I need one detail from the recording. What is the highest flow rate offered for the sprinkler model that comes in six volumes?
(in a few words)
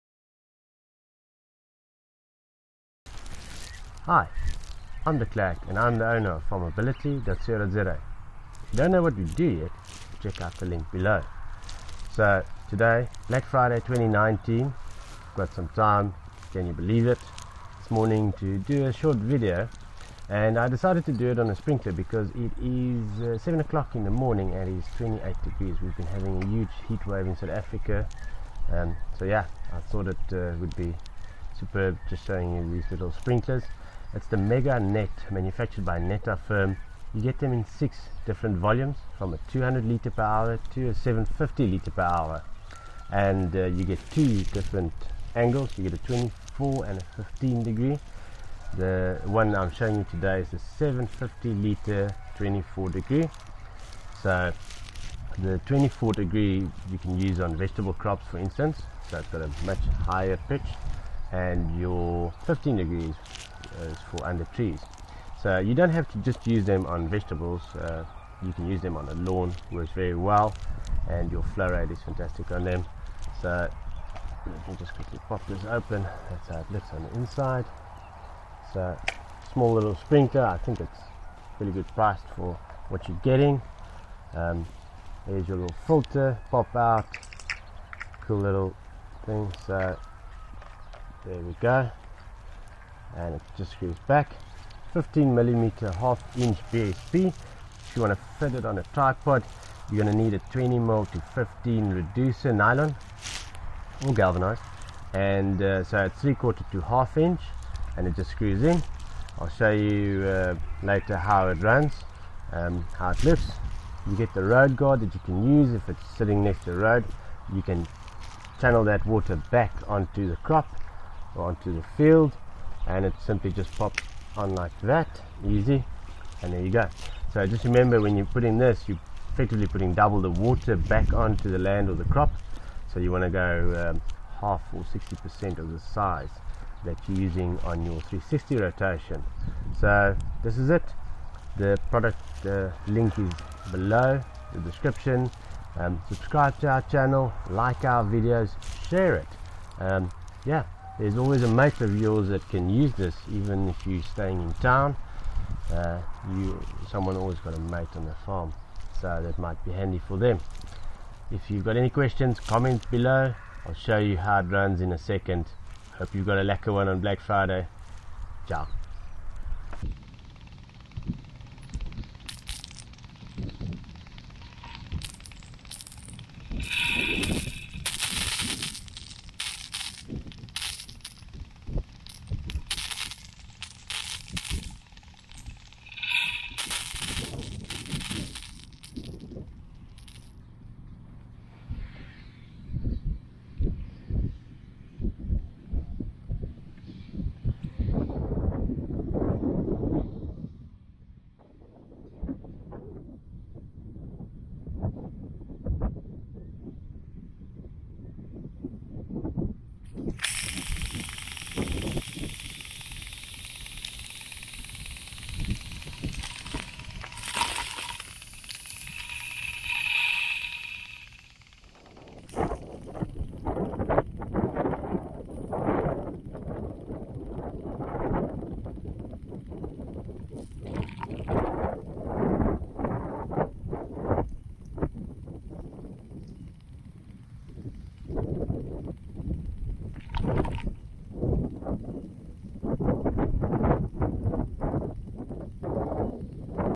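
750 liters per hour.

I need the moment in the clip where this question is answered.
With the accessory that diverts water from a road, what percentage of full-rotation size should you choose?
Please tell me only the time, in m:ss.
2:14.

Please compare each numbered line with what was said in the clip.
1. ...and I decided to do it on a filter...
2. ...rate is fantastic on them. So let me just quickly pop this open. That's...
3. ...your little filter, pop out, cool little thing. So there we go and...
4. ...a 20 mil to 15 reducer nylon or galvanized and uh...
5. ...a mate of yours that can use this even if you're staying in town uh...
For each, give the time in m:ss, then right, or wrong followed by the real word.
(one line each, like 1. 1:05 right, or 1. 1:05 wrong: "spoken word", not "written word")
1. 0:20 wrong: "sprinkler", not "filter"
2. 1:11 right
3. 1:25 right
4. 1:40 right
5. 2:31 right.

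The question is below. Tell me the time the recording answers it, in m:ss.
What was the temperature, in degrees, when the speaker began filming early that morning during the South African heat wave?
0:24.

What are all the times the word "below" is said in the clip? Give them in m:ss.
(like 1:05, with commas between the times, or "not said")
0:10, 2:23, 2:42.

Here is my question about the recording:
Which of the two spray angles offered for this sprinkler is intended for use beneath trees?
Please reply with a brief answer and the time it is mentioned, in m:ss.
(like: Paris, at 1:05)
15 degrees, at 1:02.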